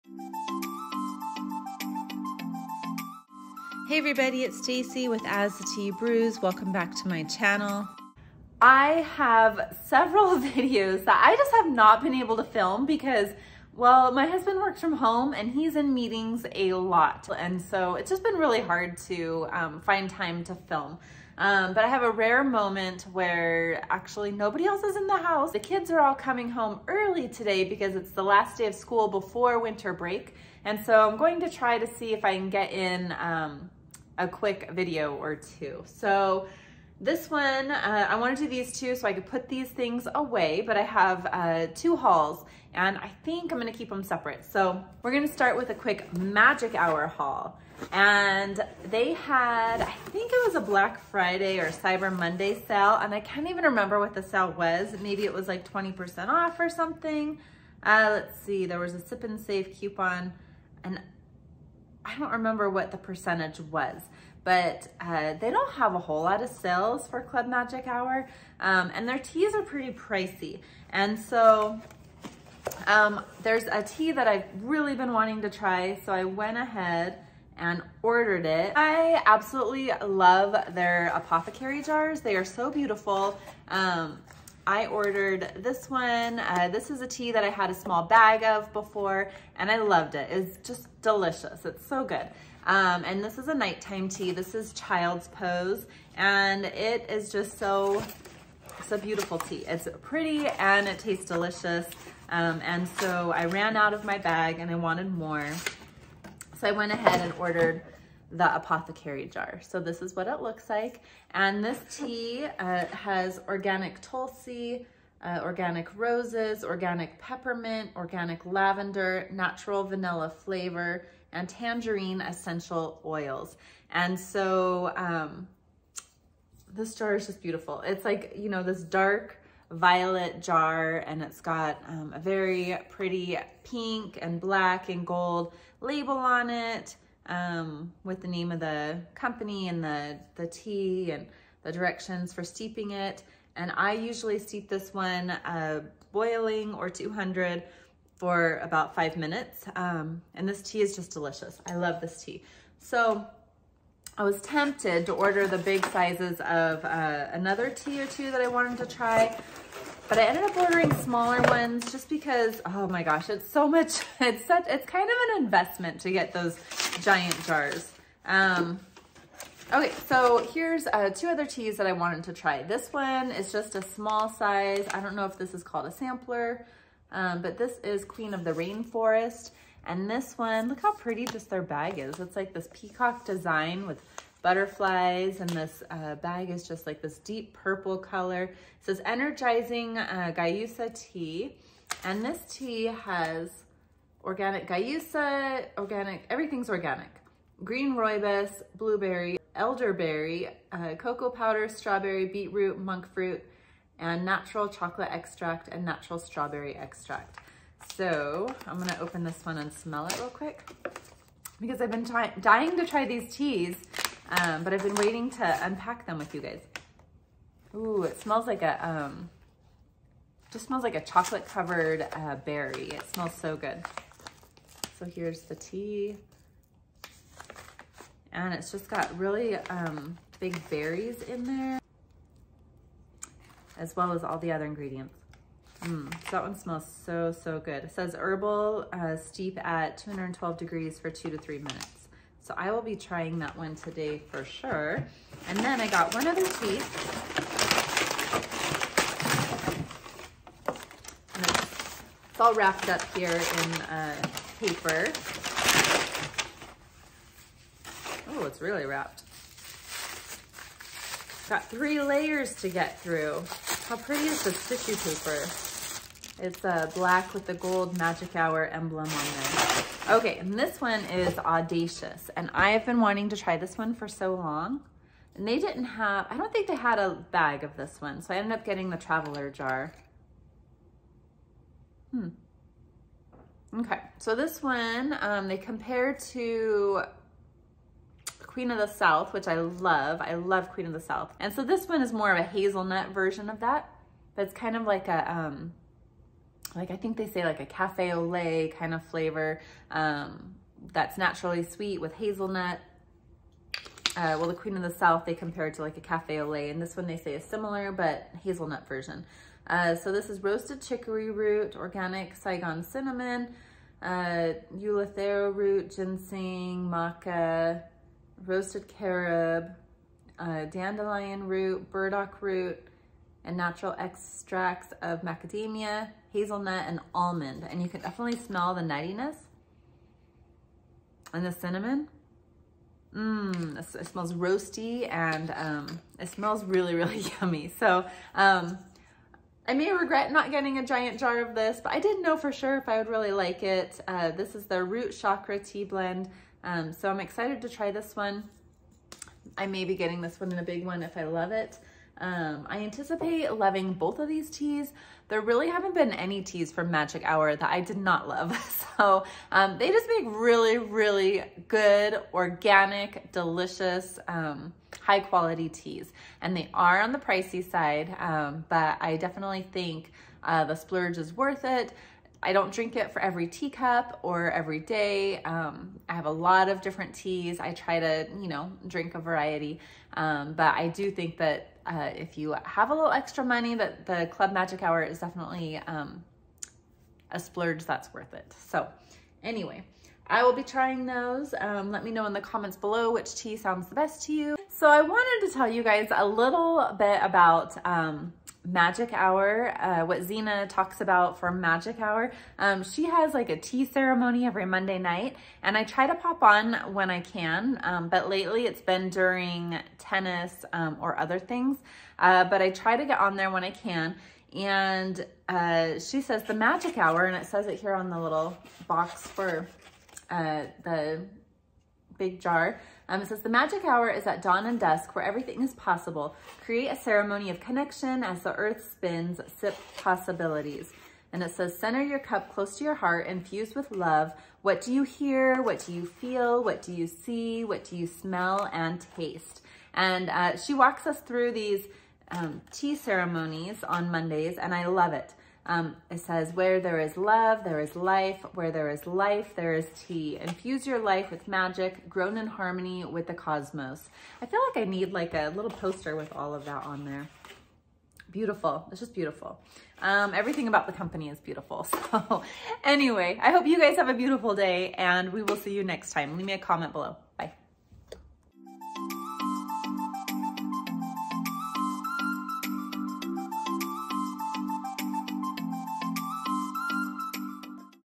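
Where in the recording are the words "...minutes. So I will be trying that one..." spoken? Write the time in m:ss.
4:01.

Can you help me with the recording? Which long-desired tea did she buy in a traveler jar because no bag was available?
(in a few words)
Audacious.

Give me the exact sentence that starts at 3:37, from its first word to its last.
Ooh, it smells like a, um, just smells like a chocolate covered uh, berry.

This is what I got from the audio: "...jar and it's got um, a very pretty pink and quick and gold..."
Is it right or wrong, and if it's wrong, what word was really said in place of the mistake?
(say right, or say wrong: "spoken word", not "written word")
wrong: "black", not "quick".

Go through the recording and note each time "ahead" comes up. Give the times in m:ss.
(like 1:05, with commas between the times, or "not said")
1:16, 1:46.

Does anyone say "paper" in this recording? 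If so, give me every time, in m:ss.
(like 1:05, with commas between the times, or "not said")
4:14, 4:24.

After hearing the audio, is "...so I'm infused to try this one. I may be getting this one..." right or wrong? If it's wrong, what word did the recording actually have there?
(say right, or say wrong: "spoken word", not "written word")
wrong: "excited", not "infused".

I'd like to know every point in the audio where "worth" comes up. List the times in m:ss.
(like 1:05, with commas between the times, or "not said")
6:11, 6:28.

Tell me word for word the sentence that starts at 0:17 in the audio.
And so it's just been really hard to um, find time to film.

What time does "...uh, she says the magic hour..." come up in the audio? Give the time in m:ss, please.
6:55.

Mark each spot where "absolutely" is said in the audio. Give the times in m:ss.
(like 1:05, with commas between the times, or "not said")
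1:19.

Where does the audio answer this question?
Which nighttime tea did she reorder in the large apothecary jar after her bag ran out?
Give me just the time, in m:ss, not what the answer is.
1:34.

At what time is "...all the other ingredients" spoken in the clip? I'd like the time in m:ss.
3:54.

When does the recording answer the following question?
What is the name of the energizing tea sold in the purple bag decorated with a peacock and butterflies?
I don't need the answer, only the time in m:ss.
2:58.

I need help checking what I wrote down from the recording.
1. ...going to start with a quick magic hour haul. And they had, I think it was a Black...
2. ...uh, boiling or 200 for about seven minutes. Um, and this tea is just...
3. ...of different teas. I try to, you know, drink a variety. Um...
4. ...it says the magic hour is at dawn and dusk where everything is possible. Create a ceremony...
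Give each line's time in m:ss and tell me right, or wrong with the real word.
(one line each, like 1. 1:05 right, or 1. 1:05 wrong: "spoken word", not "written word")
1. 0:45 right
2. 2:25 wrong: "five", not "seven"
3. 6:16 right
4. 7:03 right.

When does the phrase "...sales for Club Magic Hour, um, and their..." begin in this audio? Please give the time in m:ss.
1:06.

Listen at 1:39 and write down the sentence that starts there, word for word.
It's pretty and it tastes delicious.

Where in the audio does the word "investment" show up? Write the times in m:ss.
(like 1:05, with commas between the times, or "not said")
2:45.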